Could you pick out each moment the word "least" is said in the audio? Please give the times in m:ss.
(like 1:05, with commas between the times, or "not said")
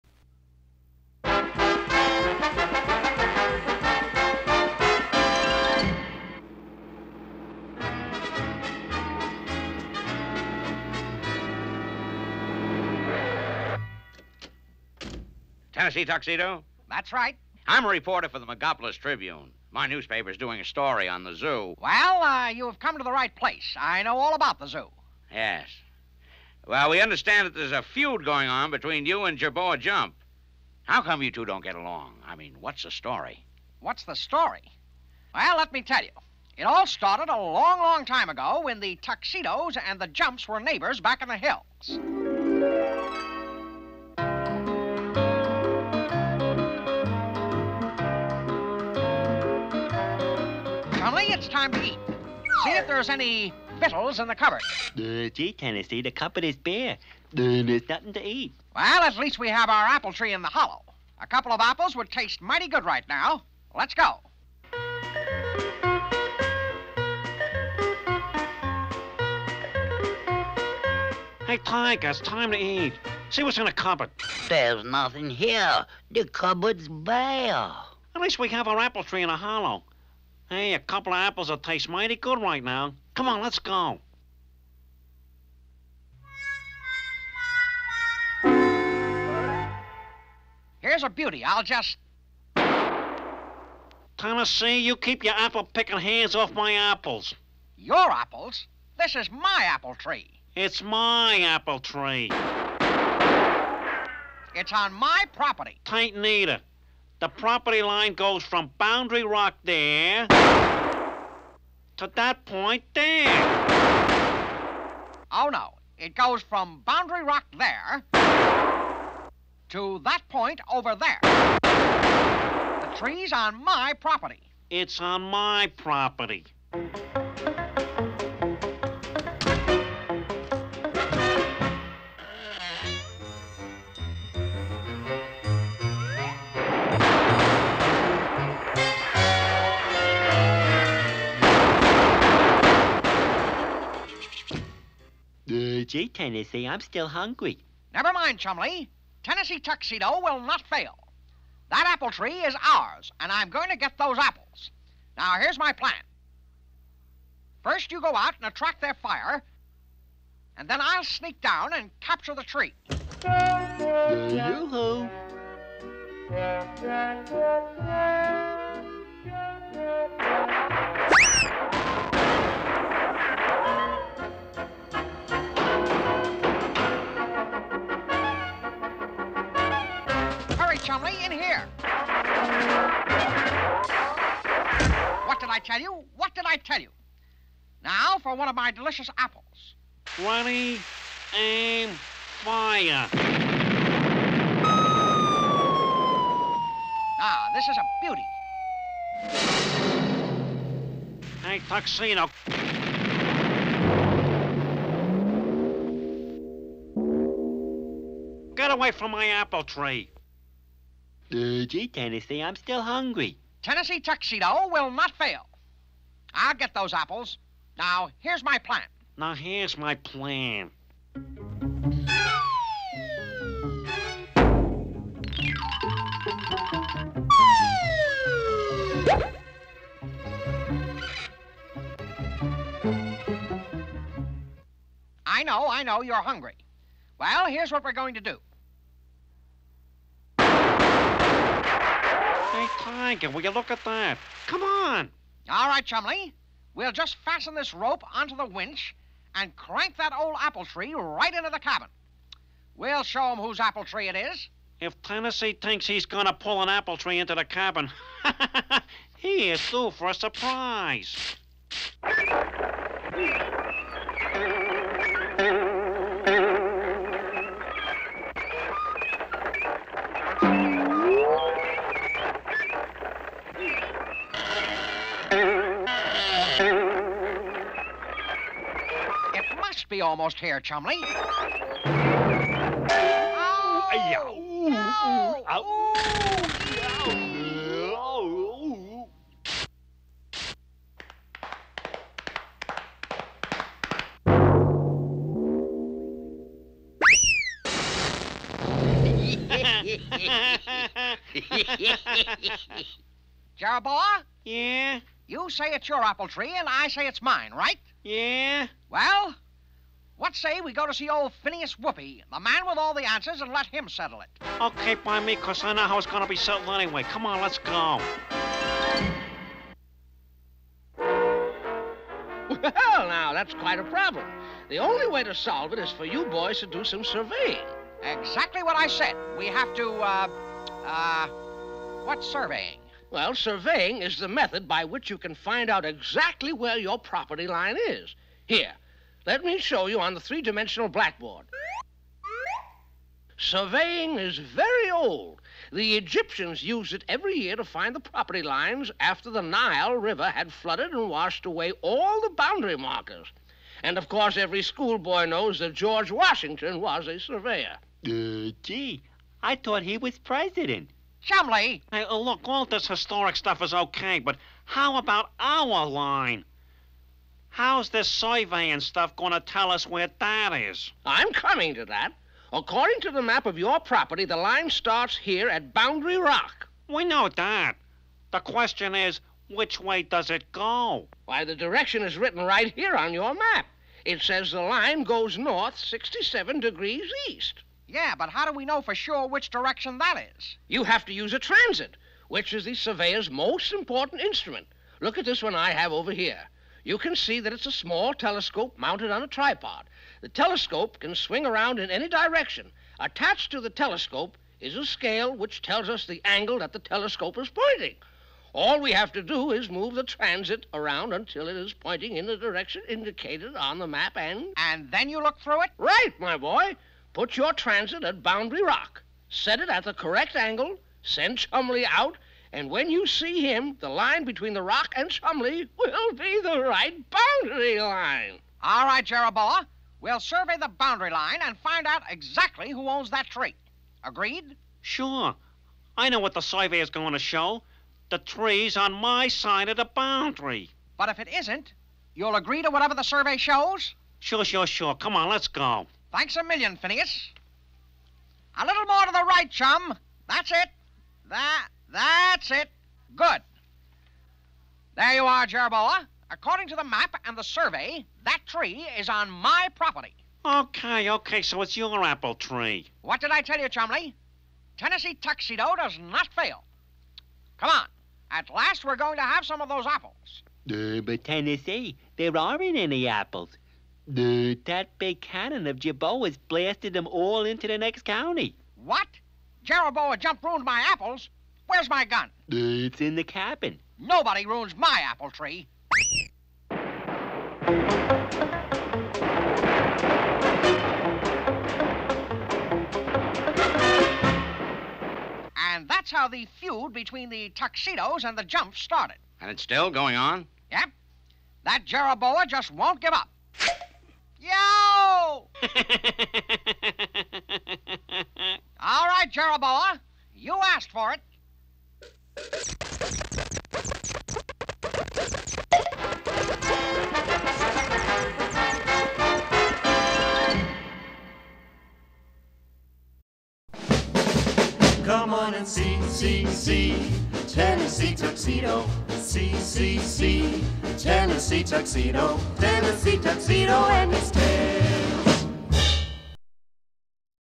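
0:59, 1:18.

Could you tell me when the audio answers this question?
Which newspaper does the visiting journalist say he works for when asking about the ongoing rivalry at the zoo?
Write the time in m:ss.
0:18.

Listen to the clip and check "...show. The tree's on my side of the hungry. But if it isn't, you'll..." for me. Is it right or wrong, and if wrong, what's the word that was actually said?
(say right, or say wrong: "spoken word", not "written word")
wrong: "boundary", not "hungry".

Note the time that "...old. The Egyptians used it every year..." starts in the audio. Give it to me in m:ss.
5:44.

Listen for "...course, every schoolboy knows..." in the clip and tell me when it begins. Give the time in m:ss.
5:54.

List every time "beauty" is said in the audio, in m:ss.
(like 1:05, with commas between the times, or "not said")
1:31, 3:18.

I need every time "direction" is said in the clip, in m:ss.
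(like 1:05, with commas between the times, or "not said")
6:21, 6:29, 6:42, 6:52.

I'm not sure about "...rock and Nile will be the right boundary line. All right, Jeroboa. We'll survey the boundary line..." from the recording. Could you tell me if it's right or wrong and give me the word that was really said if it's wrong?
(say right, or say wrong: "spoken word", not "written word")
wrong: "Chumley", not "Nile".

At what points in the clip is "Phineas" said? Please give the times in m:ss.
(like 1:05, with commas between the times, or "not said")
5:11, 7:26.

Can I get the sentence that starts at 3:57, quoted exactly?
Well, here's what we're going to do.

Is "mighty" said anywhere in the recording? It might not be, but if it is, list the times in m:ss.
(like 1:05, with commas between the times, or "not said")
1:02, 1:21.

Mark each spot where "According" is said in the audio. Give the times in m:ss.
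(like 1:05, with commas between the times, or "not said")
6:12, 7:36.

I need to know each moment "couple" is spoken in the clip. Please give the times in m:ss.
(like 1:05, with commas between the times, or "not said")
1:01, 1:20.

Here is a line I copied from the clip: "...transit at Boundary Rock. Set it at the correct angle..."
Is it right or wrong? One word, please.
right.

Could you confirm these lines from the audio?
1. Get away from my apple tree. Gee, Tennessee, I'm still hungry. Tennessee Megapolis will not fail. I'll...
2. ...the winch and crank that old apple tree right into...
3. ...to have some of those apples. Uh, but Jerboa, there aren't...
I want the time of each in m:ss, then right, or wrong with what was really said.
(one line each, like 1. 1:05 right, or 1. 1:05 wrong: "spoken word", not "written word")
1. 3:28 wrong: "Tuxedo", not "Megapolis"
2. 4:08 right
3. 7:49 wrong: "Tennessee", not "Jerboa".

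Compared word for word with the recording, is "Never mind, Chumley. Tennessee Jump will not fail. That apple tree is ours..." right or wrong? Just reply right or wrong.
wrong.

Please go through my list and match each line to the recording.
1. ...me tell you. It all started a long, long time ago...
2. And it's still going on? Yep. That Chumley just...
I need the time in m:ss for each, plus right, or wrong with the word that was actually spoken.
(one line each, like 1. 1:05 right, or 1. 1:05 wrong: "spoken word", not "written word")
1. 0:35 right
2. 8:19 wrong: "Jeroboa", not "Chumley".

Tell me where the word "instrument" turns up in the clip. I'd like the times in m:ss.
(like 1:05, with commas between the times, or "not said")
6:34.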